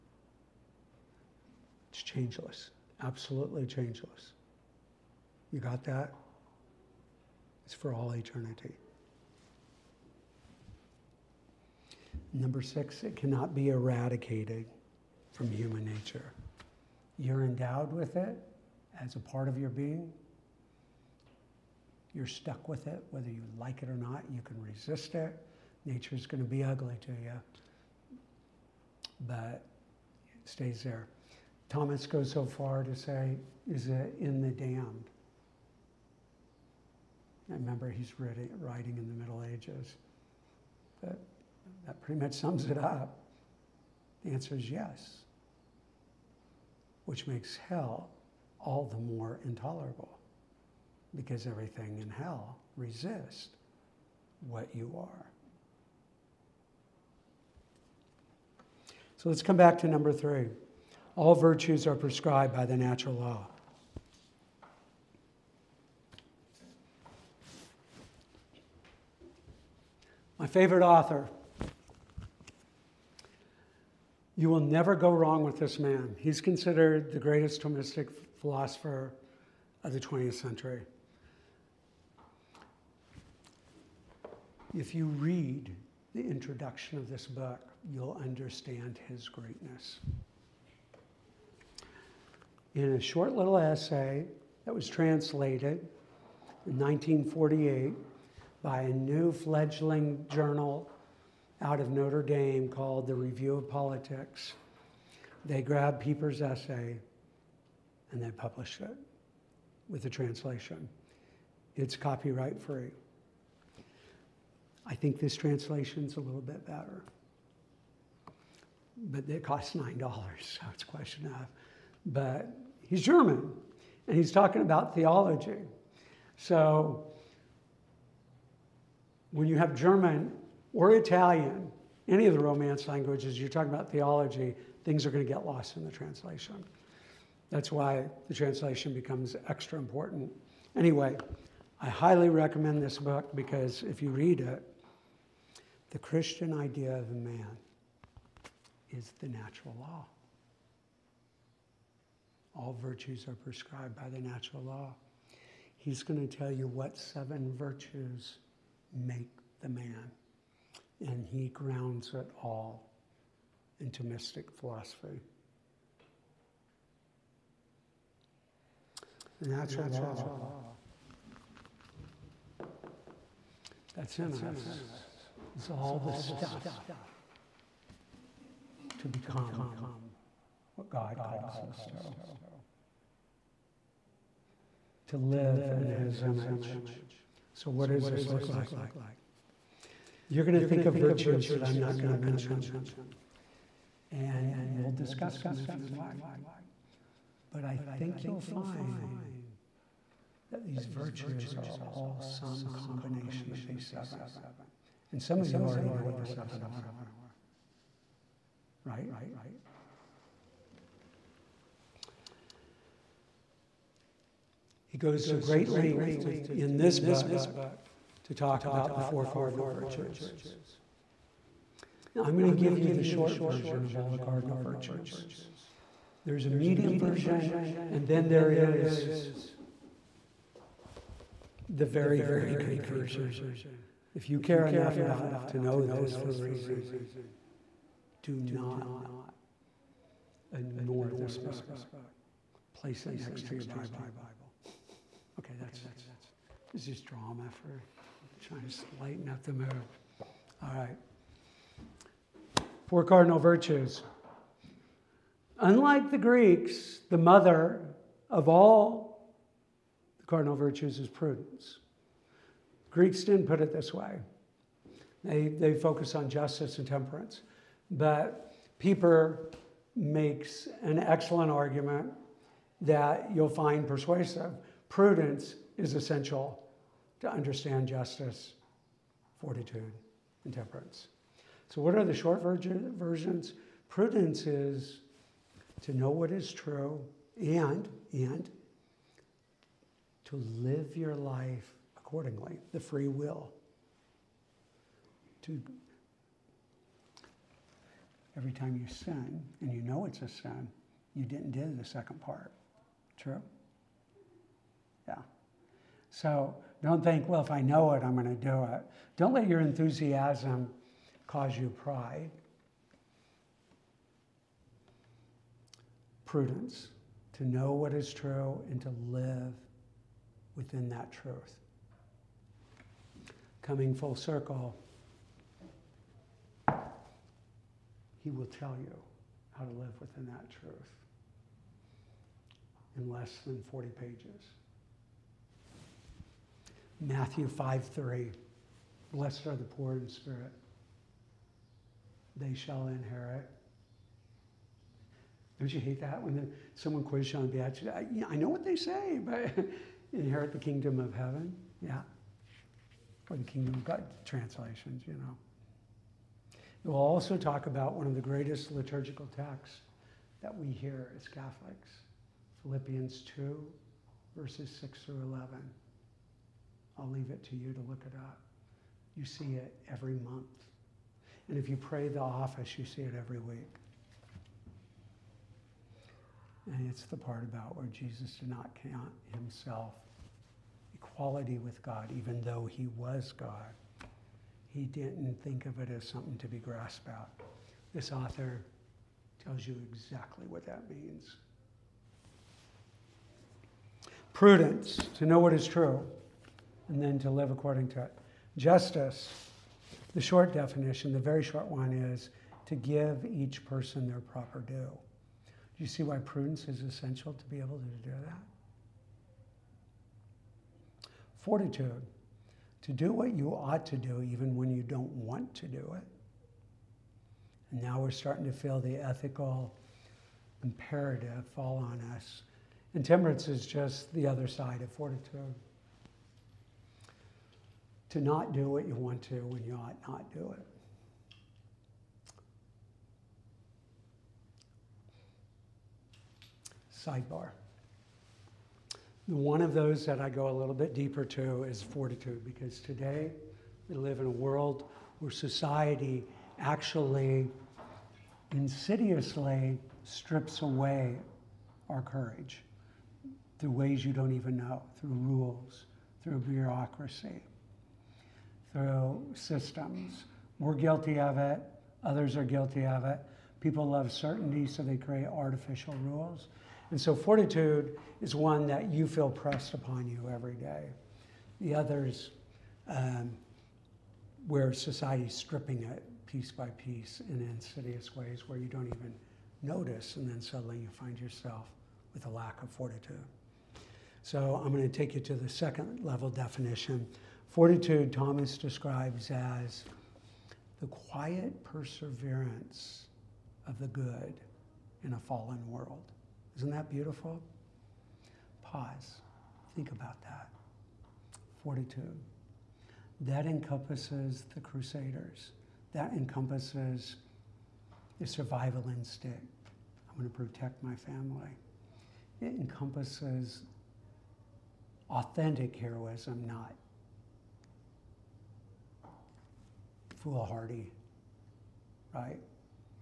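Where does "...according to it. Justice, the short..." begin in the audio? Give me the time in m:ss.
6:37.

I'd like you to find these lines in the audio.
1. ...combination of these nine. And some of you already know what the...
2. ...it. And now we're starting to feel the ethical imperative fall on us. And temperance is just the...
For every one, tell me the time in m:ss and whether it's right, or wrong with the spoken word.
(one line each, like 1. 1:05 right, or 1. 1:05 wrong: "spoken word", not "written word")
1. 3:22 wrong: "seven", not "nine"
2. 6:55 right.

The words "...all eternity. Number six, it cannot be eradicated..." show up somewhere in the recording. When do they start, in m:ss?
0:07.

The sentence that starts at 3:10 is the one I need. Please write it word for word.
you're going to think of virtues that I'm not going to mention.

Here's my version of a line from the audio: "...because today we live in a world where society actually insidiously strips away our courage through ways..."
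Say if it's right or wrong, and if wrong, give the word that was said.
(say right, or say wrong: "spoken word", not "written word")
right.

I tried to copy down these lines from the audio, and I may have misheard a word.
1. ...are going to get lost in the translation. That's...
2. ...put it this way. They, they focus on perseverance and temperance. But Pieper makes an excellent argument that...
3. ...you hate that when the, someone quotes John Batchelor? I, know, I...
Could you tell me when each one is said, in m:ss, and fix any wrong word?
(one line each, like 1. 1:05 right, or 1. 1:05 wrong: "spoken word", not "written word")
1. 2:15 right
2. 4:23 wrong: "justice", not "perseverance"
3. 5:45 right.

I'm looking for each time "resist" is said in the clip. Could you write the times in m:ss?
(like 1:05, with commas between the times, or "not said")
0:24, 0:52.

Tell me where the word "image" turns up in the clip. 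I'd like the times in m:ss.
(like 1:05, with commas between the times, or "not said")
3:06.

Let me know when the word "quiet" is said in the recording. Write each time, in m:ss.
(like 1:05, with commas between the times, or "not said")
8:10.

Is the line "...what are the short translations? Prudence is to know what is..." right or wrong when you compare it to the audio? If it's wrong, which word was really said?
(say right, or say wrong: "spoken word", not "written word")
wrong: "versions", not "translations".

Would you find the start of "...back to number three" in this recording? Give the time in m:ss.
0:59.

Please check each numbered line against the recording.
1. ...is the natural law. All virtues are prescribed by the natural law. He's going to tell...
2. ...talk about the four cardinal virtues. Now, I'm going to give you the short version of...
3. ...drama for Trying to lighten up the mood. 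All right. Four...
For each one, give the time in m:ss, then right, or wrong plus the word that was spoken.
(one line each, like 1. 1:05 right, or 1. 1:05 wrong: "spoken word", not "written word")
1. 2:28 right
2. 3:38 right
3. 4:07 right.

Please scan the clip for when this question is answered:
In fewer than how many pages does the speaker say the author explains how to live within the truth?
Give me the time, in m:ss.
5:33.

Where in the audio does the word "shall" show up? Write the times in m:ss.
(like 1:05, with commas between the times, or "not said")
5:42.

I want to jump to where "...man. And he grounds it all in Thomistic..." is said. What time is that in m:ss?
2:39.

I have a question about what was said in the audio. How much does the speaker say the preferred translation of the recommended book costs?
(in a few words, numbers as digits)
$9.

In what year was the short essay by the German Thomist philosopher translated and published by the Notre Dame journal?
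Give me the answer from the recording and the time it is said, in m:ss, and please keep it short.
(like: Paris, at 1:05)
1948, at 1:36.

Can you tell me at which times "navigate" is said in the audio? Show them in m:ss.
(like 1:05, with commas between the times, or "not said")
not said.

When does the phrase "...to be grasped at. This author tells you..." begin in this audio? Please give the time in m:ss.
6:26.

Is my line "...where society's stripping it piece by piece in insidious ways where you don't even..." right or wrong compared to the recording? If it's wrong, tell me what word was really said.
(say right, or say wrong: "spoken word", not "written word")
right.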